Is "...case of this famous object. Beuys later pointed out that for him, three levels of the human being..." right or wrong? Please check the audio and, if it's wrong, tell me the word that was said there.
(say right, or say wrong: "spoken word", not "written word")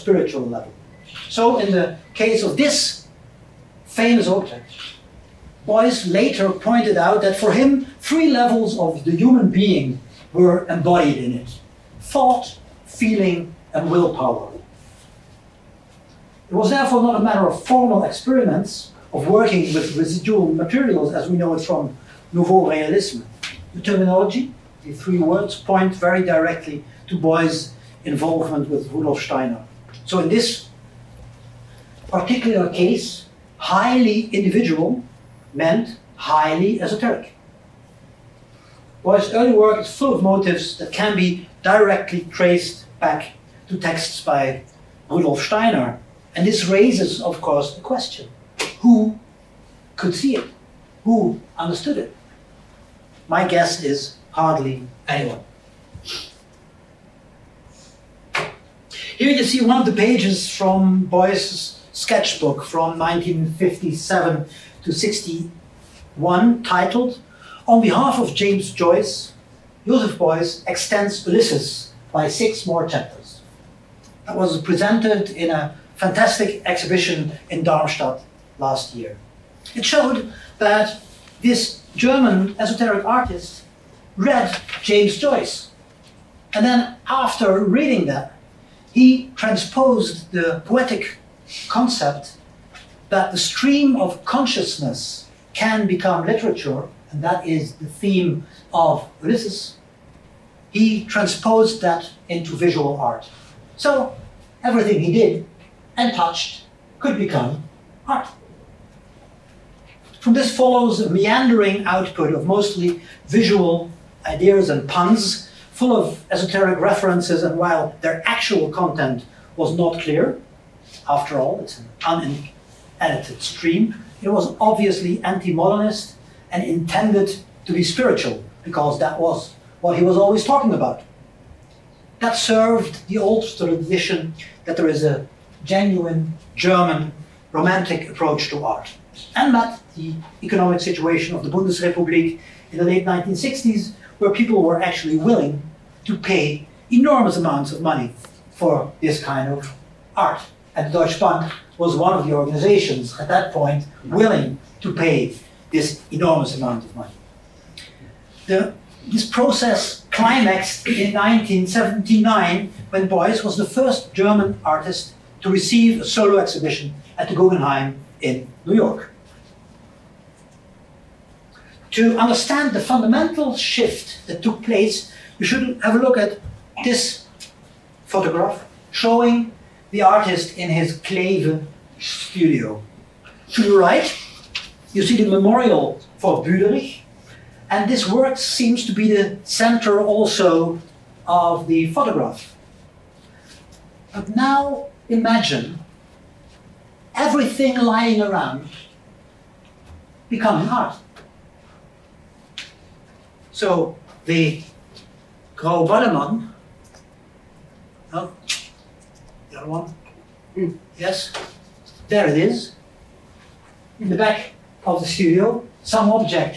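right.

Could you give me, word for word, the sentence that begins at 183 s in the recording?
To the right, you see the memorial for Büderich, and this work seems to be the center also of the photograph.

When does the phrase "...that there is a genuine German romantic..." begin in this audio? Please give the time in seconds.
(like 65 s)
134 s.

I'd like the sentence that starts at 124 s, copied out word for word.
It was obviously anti-modernist and intended to be spiritual because that was what he was always talking about.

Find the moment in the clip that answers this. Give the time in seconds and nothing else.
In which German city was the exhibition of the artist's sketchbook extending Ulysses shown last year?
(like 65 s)
77 s.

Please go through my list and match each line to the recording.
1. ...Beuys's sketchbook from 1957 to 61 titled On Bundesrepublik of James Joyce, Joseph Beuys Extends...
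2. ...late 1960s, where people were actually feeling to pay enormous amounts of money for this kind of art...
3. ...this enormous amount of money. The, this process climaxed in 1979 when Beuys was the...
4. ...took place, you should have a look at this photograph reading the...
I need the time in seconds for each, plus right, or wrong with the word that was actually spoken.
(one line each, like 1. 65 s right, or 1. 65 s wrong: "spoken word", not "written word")
1. 61 s wrong: "Behalf", not "Bundesrepublik"
2. 142 s wrong: "willing", not "feeling"
3. 155 s right
4. 174 s wrong: "showing", not "reading".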